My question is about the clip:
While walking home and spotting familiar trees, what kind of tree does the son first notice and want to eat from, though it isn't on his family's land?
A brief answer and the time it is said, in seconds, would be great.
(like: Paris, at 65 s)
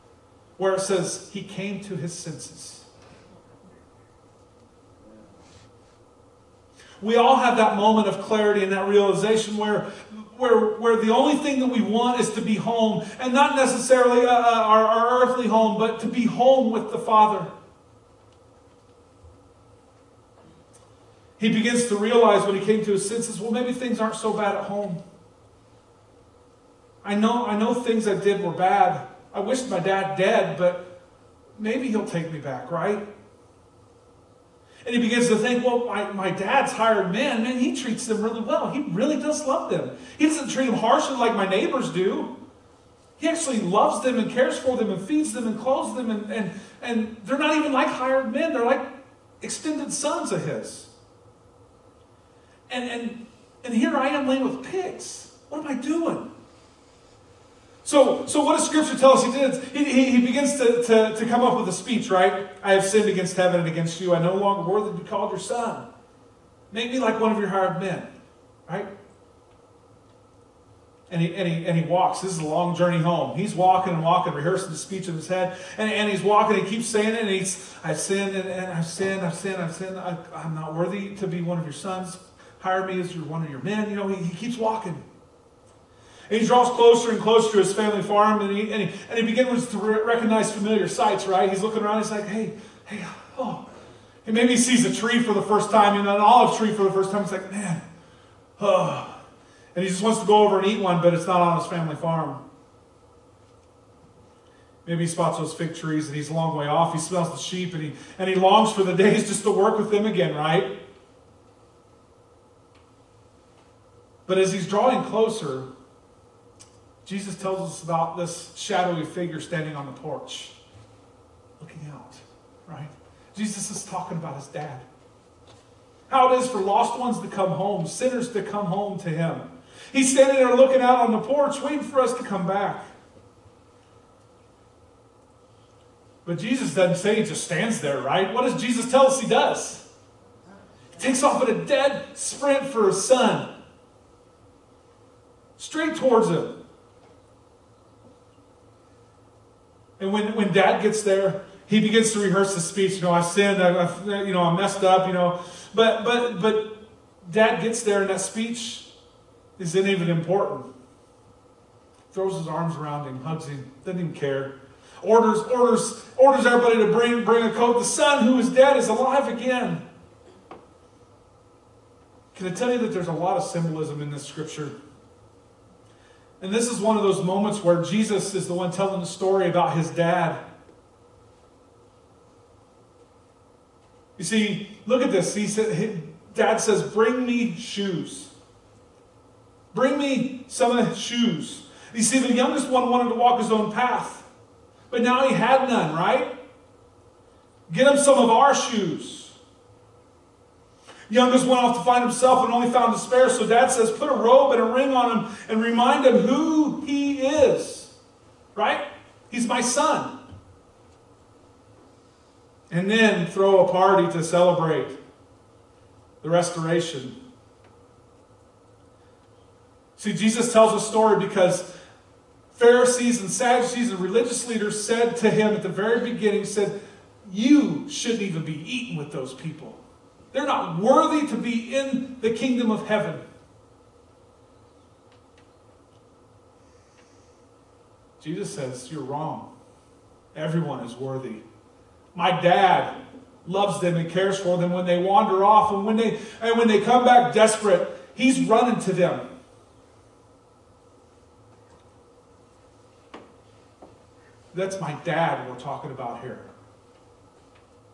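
olive tree, at 96 s.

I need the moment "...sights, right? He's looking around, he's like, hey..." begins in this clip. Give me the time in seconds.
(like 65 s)
90 s.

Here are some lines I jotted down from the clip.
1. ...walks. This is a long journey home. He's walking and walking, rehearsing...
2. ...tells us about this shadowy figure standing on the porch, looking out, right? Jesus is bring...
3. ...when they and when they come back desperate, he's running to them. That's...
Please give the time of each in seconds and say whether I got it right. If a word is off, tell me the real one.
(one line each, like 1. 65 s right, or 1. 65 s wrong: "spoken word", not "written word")
1. 71 s right
2. 117 s wrong: "talking", not "bring"
3. 245 s right.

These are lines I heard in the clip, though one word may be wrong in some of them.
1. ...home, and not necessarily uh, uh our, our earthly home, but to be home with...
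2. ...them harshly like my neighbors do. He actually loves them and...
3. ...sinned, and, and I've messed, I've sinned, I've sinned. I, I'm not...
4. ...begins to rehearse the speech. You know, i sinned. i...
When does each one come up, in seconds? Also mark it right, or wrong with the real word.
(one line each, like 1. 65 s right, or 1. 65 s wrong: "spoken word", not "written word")
1. 12 s right
2. 40 s right
3. 77 s wrong: "sinned", not "messed"
4. 151 s right.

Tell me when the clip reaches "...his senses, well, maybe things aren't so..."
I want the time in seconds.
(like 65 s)
22 s.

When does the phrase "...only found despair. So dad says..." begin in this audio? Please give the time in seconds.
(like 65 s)
202 s.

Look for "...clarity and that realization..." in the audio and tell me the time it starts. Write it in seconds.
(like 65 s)
8 s.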